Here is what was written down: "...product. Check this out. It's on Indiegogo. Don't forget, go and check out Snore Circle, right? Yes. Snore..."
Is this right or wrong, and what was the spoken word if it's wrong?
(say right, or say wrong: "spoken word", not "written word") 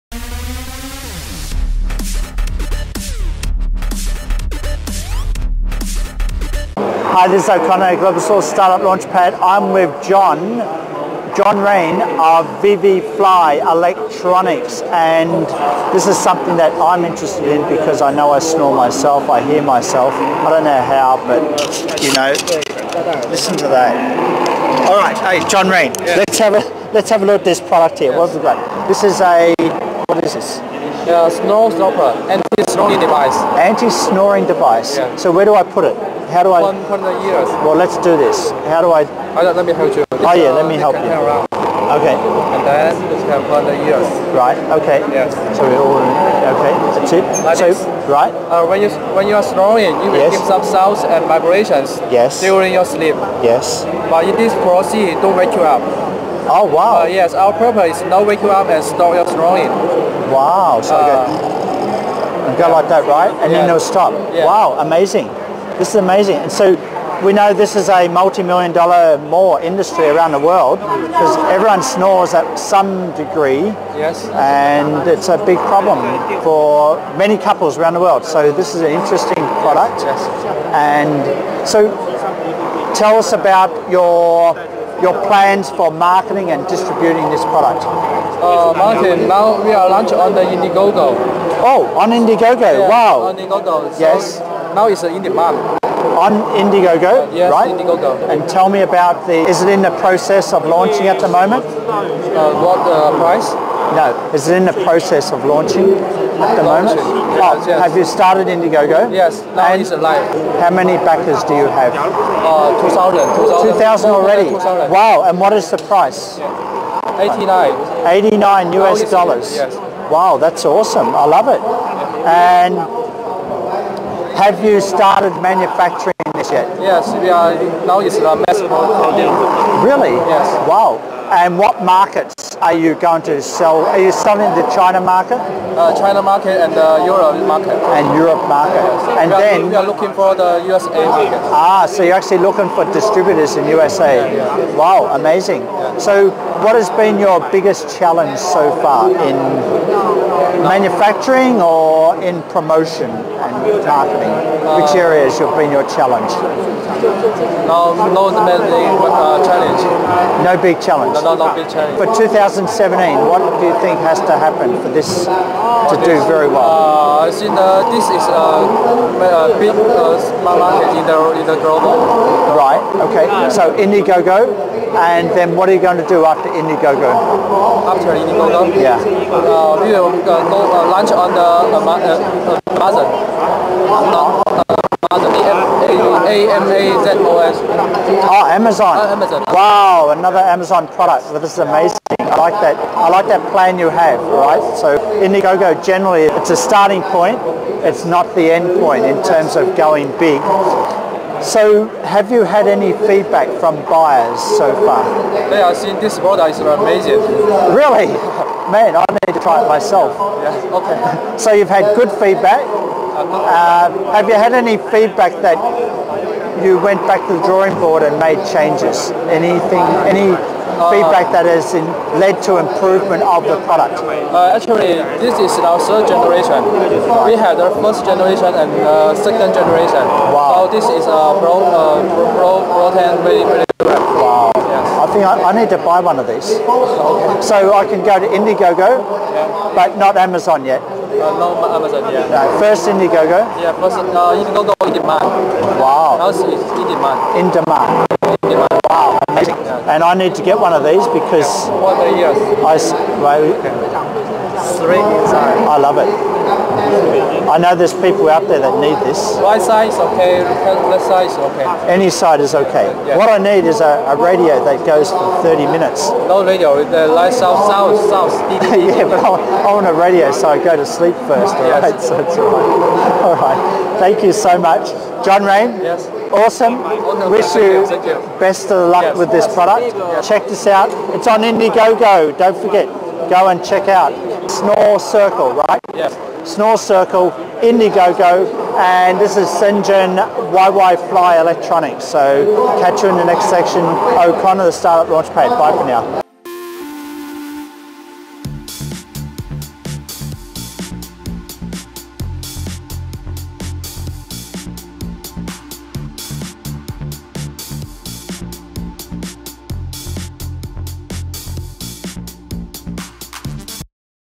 right.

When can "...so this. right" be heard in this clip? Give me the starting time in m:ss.
0:47.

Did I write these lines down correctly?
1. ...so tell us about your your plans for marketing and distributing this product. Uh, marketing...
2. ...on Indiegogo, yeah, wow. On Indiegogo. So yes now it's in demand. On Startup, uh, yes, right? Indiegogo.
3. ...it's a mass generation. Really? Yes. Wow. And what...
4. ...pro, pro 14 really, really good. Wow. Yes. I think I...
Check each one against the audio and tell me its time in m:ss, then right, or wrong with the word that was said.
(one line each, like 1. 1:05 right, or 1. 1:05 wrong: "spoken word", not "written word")
1. 1:21 right
2. 1:31 wrong: "Indiegogo", not "Startup"
3. 2:07 wrong: "production", not "generation"
4. 3:52 wrong: "10", not "14".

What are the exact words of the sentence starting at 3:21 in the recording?
So have you had any feedback from buyers so far?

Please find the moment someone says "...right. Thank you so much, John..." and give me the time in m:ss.
4:33.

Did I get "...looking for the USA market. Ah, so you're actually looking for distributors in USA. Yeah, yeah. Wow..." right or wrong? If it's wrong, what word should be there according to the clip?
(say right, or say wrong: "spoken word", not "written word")
right.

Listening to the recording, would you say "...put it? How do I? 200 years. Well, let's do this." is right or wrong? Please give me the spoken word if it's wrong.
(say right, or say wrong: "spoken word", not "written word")
wrong: "100", not "200".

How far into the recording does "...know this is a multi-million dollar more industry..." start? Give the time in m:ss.
1:07.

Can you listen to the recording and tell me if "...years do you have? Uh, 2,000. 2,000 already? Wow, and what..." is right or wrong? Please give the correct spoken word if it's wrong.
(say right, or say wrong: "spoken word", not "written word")
wrong: "backers", not "years".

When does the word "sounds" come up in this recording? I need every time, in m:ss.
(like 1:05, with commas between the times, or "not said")
0:50.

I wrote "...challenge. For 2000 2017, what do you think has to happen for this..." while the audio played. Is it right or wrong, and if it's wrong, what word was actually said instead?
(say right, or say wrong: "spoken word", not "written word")
right.